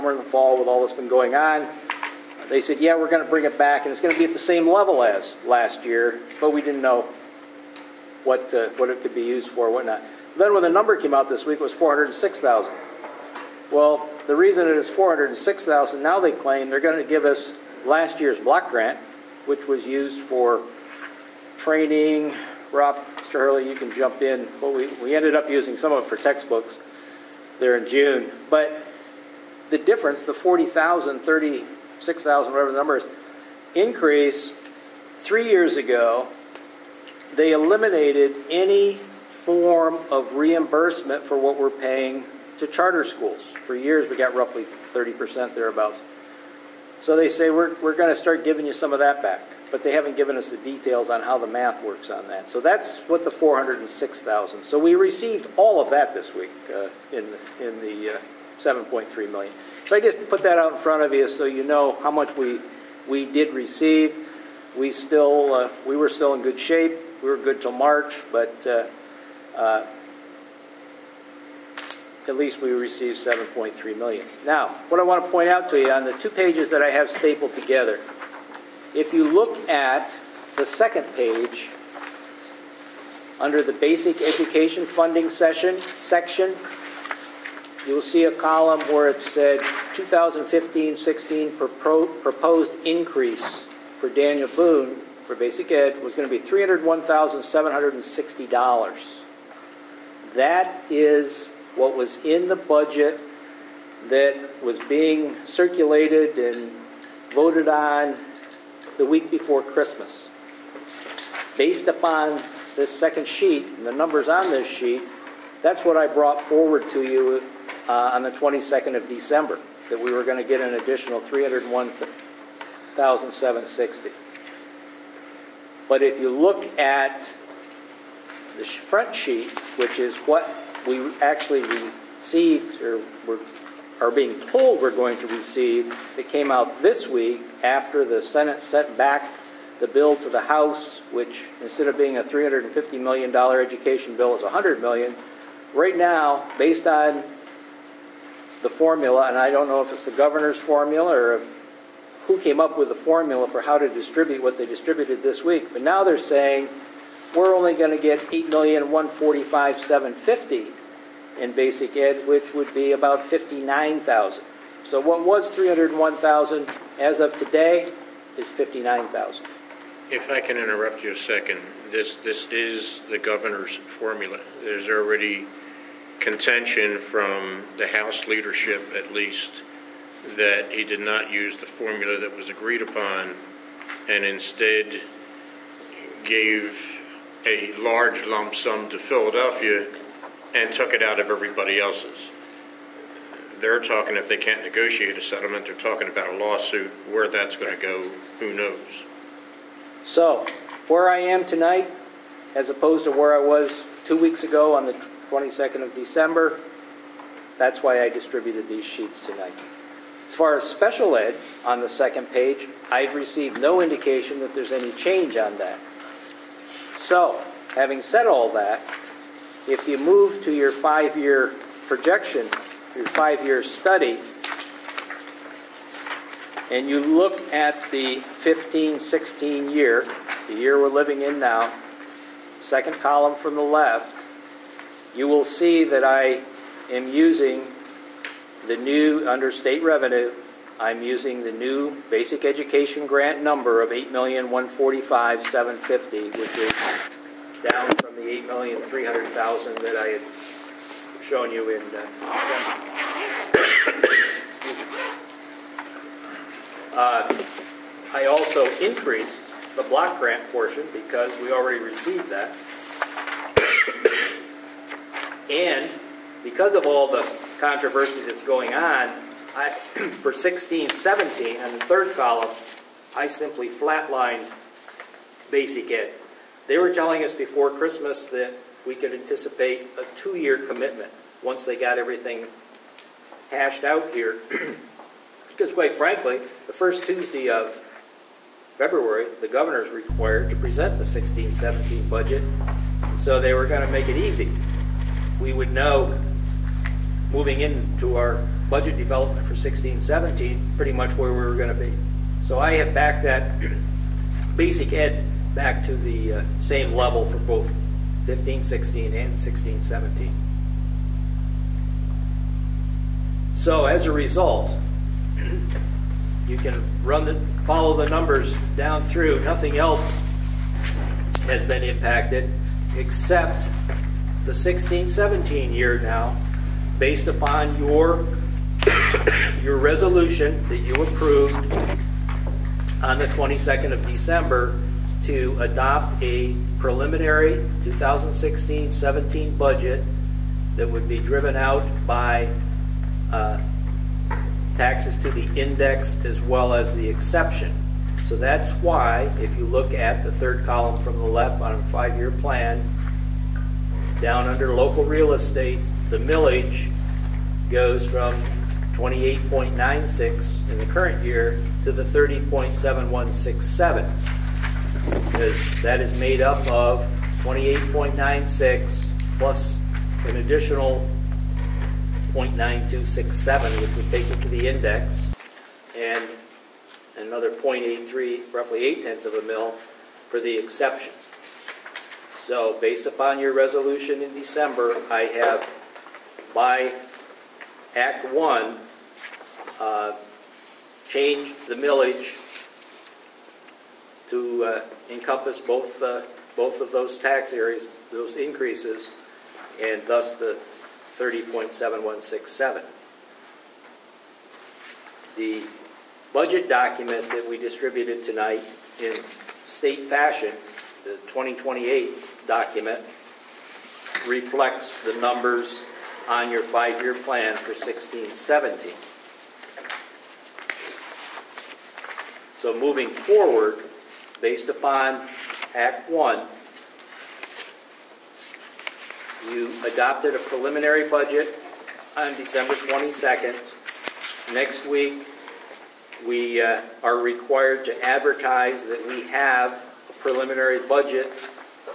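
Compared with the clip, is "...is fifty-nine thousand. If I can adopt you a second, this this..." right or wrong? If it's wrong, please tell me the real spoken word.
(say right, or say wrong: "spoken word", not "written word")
wrong: "interrupt", not "adopt".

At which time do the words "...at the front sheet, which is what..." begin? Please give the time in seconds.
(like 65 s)
126 s.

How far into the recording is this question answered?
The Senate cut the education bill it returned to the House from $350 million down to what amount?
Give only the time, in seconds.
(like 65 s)
144 s.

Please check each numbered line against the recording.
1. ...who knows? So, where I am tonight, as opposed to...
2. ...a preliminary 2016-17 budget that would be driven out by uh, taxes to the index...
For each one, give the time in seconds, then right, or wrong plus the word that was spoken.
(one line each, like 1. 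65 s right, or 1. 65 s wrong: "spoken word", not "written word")
1. 198 s right
2. 336 s right.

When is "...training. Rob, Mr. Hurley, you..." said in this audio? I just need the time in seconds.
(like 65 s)
21 s.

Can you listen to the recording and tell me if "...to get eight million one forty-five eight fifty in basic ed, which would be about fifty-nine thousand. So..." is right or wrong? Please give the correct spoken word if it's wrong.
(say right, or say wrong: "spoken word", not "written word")
wrong: "seven", not "eight".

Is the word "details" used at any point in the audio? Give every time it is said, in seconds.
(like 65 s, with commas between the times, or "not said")
50 s.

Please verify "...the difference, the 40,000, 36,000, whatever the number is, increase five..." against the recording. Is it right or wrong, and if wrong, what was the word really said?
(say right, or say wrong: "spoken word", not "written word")
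wrong: "three", not "five".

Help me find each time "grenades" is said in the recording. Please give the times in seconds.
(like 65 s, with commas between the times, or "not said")
not said.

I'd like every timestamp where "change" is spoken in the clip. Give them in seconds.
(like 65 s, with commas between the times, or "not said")
214 s, 391 s.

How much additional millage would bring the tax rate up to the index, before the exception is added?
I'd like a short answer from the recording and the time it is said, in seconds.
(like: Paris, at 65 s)
0.9267, at 372 s.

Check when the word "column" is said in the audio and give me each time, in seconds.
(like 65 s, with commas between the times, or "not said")
88 s, 232 s, 272 s, 350 s.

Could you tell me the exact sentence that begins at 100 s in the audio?
That is what was in the budget that was being circulated and voted on the week before Christmas.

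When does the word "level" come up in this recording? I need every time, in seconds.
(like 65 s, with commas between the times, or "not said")
4 s, 306 s.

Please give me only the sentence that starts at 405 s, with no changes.
The budget document that we distributed tonight in state fashion, the 2028 document, reflects the numbers on your five-year plan for 1617.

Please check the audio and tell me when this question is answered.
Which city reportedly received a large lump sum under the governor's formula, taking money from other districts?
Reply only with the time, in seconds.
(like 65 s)
188 s.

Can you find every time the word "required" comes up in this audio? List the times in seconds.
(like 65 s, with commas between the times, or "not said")
289 s, 437 s.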